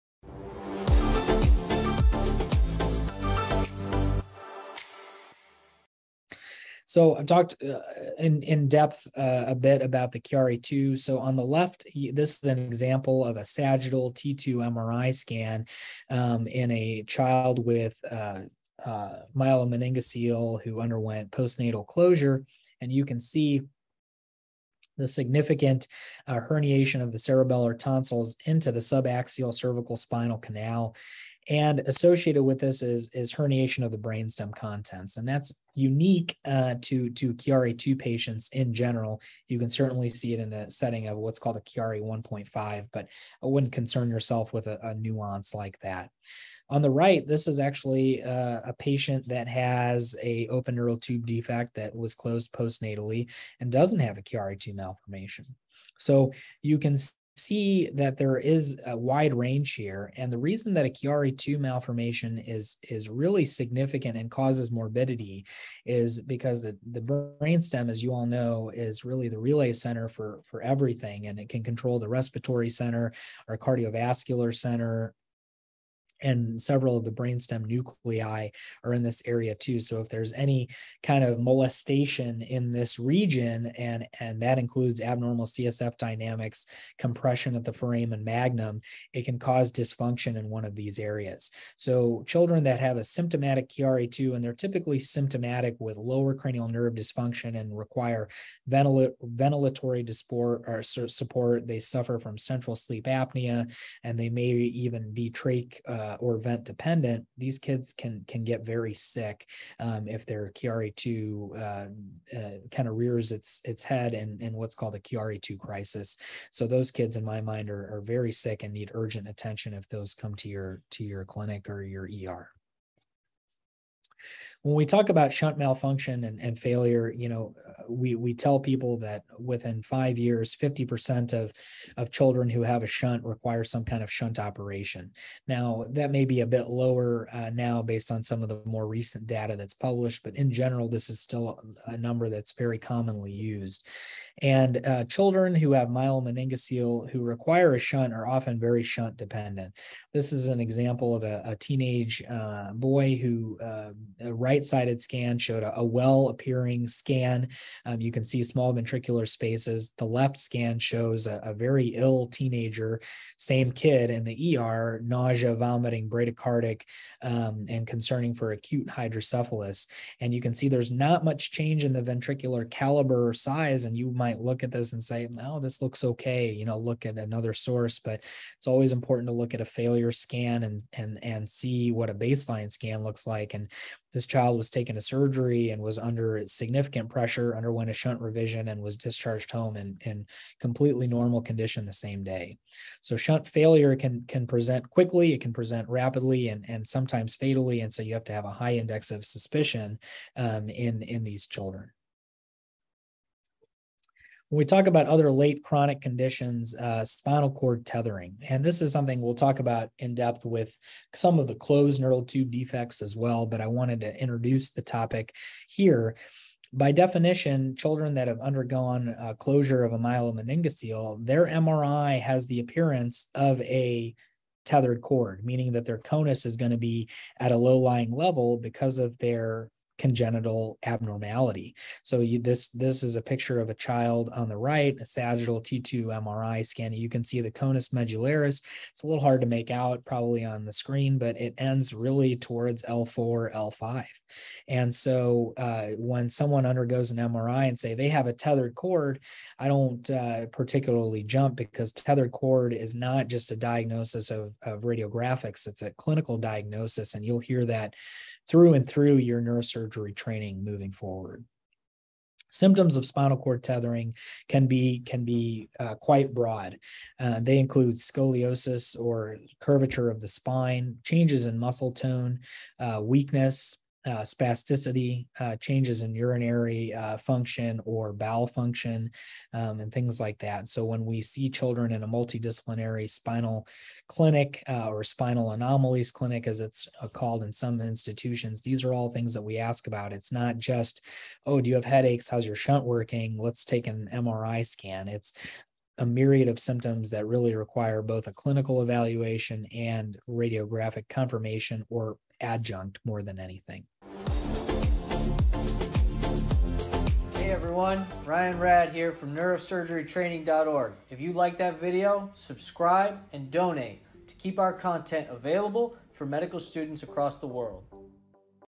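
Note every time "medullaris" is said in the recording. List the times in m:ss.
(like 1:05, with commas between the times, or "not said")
3:57.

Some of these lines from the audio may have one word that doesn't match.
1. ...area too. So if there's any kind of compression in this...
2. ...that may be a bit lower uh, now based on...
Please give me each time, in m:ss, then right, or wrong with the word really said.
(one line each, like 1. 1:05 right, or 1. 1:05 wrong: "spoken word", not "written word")
1. 1:19 wrong: "molestation", not "compression"
2. 2:15 right.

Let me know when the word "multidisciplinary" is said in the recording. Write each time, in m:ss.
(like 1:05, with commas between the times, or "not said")
4:42.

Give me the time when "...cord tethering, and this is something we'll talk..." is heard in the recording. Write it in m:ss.
3:27.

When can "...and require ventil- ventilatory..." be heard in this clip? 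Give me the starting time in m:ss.
1:37.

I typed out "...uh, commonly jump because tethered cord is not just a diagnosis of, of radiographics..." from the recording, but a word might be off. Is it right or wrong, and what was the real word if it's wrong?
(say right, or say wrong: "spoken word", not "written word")
wrong: "particularly", not "commonly".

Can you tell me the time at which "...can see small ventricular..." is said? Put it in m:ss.
2:38.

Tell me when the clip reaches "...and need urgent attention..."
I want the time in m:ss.
1:58.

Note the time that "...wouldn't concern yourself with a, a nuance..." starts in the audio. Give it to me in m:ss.
0:43.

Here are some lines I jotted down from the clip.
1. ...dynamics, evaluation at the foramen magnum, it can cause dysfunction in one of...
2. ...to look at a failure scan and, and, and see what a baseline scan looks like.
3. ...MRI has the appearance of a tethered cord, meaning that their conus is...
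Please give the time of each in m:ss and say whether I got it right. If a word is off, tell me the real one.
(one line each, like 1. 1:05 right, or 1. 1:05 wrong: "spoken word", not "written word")
1. 1:25 wrong: "compression", not "evaluation"
2. 2:59 right
3. 3:41 right.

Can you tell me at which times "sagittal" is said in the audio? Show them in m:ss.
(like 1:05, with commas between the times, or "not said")
0:13, 3:55.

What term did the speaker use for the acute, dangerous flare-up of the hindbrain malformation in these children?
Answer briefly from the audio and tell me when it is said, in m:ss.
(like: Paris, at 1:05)
Chiari 2 crisis, at 1:54.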